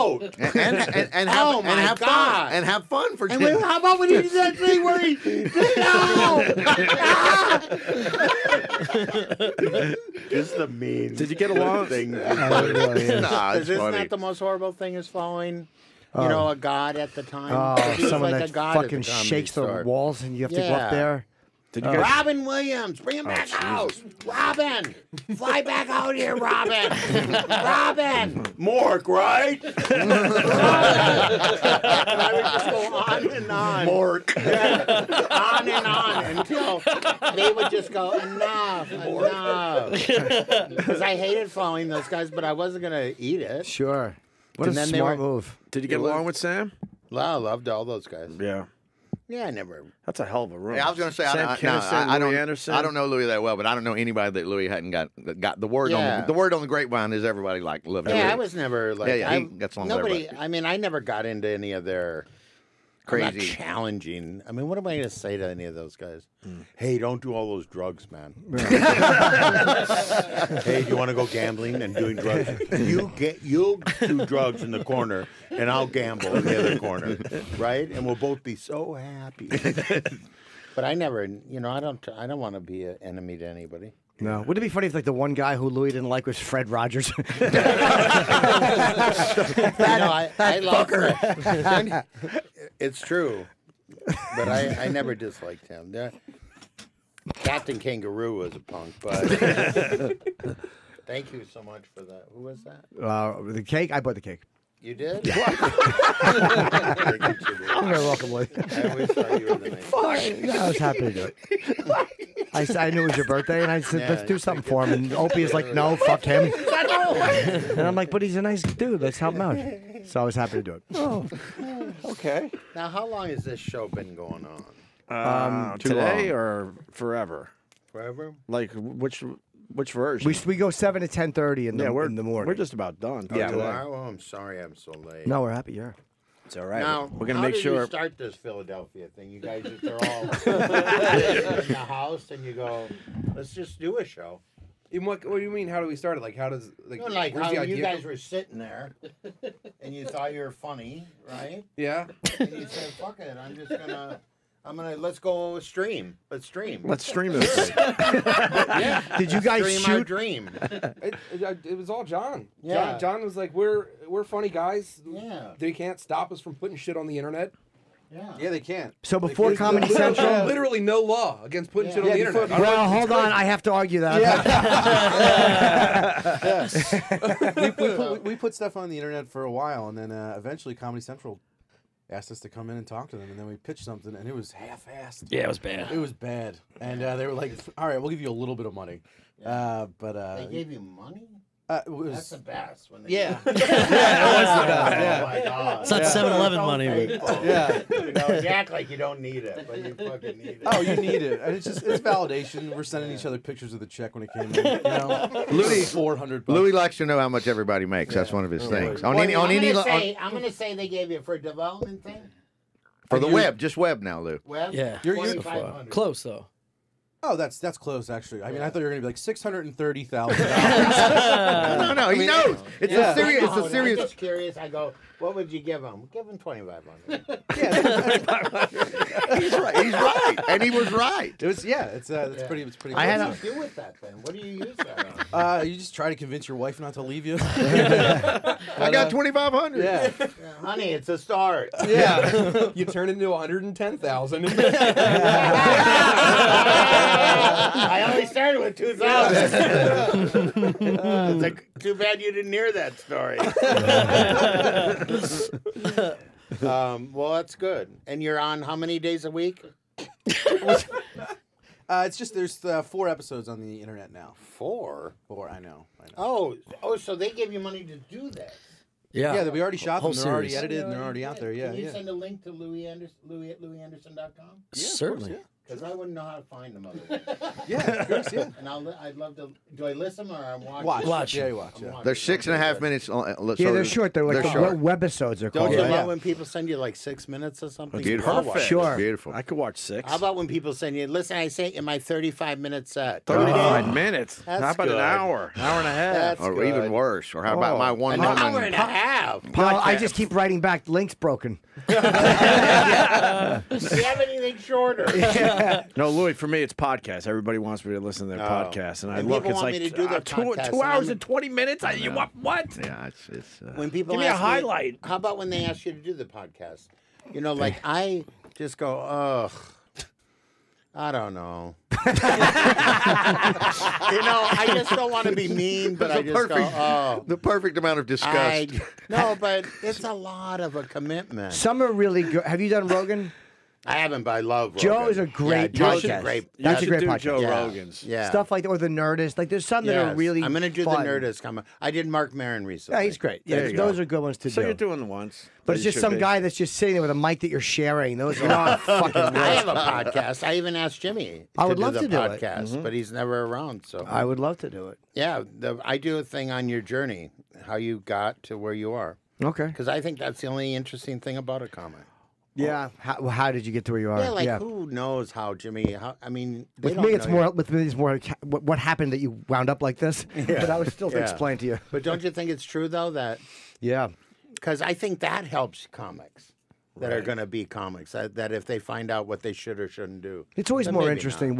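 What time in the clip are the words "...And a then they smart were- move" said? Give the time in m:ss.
0:44.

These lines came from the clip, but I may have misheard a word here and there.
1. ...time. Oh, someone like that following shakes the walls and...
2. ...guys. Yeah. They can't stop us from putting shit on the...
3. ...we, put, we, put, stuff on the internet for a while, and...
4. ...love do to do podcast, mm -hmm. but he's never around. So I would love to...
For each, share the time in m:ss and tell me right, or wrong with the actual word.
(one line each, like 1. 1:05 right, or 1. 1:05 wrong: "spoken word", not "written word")
1. 0:17 wrong: "fucking", not "following"
2. 2:44 right
3. 2:57 right
4. 5:51 right.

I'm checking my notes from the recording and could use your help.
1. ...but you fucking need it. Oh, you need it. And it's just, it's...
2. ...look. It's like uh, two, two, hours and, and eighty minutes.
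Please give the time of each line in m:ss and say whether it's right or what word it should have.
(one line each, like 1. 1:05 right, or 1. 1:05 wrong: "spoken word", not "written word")
1. 3:19 right
2. 5:09 wrong: "twenty", not "eighty".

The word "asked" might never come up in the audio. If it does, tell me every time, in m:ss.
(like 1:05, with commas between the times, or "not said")
3:02, 5:50.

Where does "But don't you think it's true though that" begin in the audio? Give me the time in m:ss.
6:11.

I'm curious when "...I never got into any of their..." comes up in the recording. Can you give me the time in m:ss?
1:00.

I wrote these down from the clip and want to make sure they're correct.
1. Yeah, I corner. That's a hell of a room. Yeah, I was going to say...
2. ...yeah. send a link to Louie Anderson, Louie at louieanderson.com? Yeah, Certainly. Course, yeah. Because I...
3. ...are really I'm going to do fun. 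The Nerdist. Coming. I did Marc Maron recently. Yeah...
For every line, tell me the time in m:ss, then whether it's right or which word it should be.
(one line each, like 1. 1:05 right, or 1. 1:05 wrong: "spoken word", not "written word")
1. 0:49 wrong: "never", not "corner"
2. 4:31 right
3. 5:40 right.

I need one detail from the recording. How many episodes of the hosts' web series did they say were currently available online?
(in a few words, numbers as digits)
4.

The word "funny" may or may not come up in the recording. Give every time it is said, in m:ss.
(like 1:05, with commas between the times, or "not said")
0:13, 1:24, 2:30, 2:44.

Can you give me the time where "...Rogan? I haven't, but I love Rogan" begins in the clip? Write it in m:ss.
5:32.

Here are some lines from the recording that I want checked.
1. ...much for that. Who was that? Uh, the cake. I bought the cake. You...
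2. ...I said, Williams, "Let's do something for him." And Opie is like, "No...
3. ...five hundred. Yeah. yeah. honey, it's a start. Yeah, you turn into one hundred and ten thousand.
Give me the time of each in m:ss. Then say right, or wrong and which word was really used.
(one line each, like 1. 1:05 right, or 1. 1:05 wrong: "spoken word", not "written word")
1. 1:41 right
2. 1:53 wrong: "Yeah", not "Williams"
3. 3:59 right.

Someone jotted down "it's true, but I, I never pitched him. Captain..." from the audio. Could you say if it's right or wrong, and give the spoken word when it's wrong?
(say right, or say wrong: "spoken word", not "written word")
wrong: "disliked", not "pitched".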